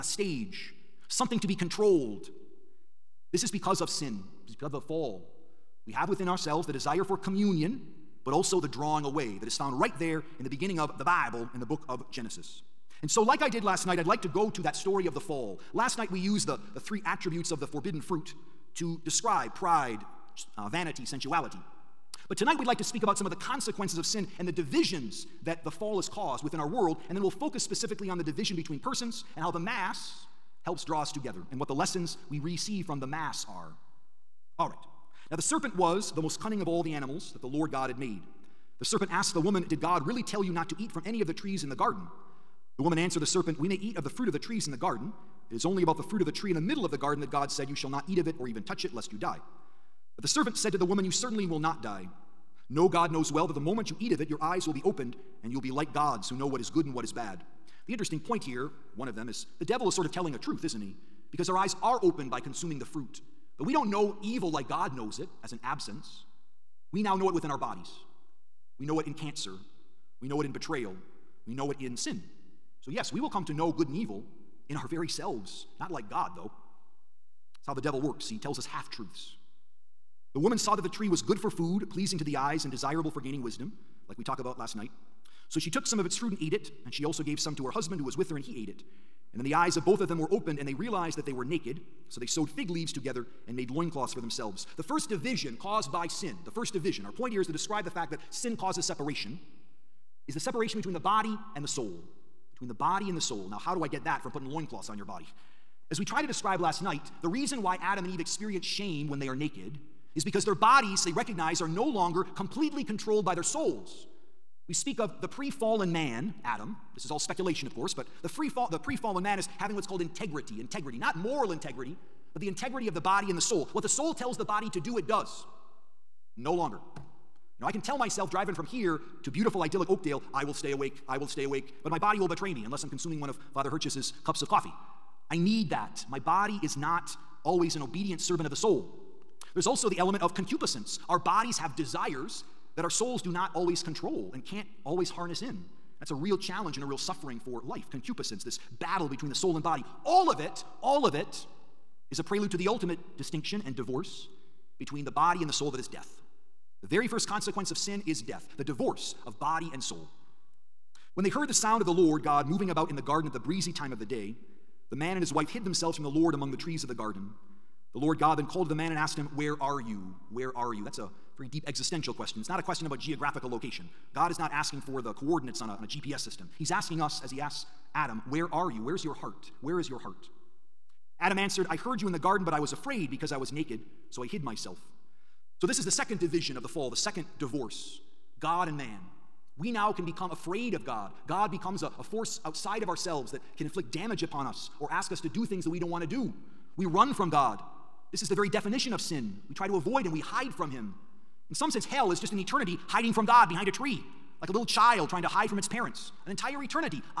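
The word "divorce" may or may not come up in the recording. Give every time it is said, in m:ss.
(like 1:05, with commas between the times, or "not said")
2:33, 2:38, 3:07.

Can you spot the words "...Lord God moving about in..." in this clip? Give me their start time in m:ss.
2:41.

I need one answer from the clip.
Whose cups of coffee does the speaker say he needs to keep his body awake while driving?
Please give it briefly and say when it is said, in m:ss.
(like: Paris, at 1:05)
Father Hurchis, at 2:13.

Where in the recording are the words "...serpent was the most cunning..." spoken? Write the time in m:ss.
0:35.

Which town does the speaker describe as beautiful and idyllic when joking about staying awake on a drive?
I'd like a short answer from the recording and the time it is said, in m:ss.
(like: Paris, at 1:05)
Oakdale, at 2:09.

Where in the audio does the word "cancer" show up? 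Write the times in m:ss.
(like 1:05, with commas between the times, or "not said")
1:09.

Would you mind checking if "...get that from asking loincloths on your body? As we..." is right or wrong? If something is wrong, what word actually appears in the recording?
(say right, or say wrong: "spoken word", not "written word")
wrong: "putting", not "asking".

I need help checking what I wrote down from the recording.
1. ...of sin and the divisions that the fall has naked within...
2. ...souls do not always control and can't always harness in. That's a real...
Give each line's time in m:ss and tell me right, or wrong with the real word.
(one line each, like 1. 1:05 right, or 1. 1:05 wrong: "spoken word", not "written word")
1. 0:23 wrong: "caused", not "naked"
2. 2:22 right.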